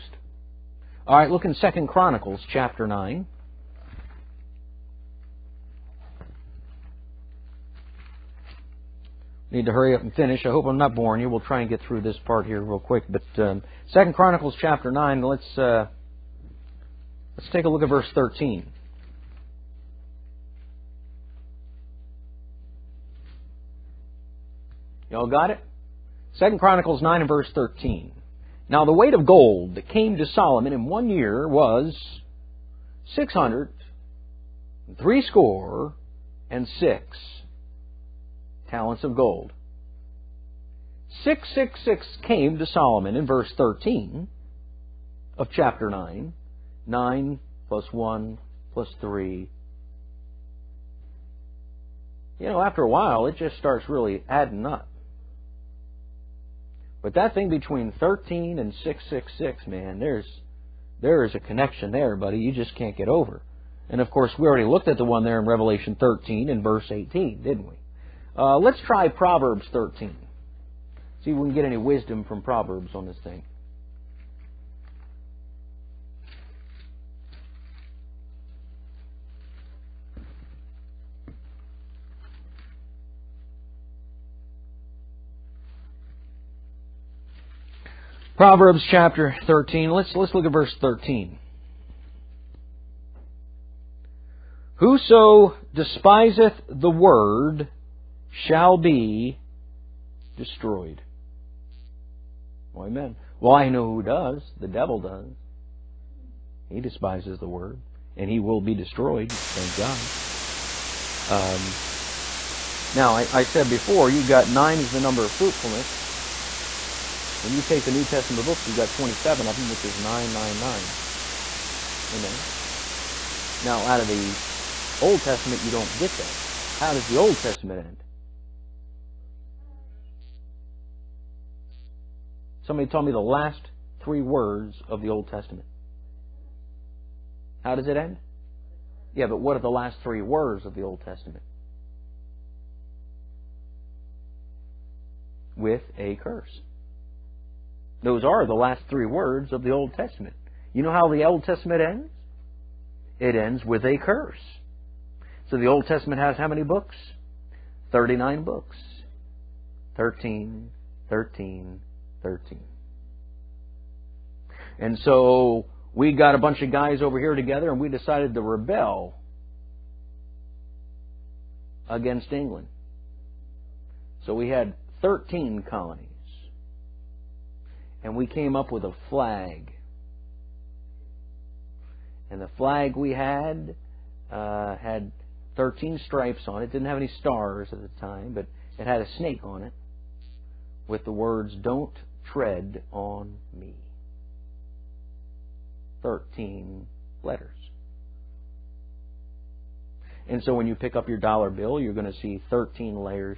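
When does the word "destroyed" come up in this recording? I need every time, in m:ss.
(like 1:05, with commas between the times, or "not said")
1:40, 1:48.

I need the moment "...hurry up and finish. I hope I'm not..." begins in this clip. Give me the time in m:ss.
0:09.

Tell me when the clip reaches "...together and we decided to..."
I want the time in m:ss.
2:47.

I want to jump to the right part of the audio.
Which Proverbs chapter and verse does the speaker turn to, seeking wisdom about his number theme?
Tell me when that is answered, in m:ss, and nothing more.
1:28.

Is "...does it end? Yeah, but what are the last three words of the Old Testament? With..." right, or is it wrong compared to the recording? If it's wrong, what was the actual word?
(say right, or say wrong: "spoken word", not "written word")
right.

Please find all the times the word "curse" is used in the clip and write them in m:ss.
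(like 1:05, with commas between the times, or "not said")
2:26, 2:34.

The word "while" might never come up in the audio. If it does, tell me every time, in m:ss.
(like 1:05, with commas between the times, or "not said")
0:52.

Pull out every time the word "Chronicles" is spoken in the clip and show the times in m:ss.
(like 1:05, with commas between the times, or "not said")
0:01, 0:14, 0:26.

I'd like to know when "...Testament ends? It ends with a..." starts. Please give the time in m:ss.
2:31.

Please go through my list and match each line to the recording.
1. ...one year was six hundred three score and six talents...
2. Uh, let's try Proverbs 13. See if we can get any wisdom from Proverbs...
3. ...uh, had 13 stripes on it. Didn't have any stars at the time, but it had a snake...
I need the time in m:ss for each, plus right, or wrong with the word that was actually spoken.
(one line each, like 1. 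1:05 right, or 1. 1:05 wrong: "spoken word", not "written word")
1. 0:30 right
2. 1:08 right
3. 3:04 right.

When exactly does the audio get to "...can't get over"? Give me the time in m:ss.
1:02.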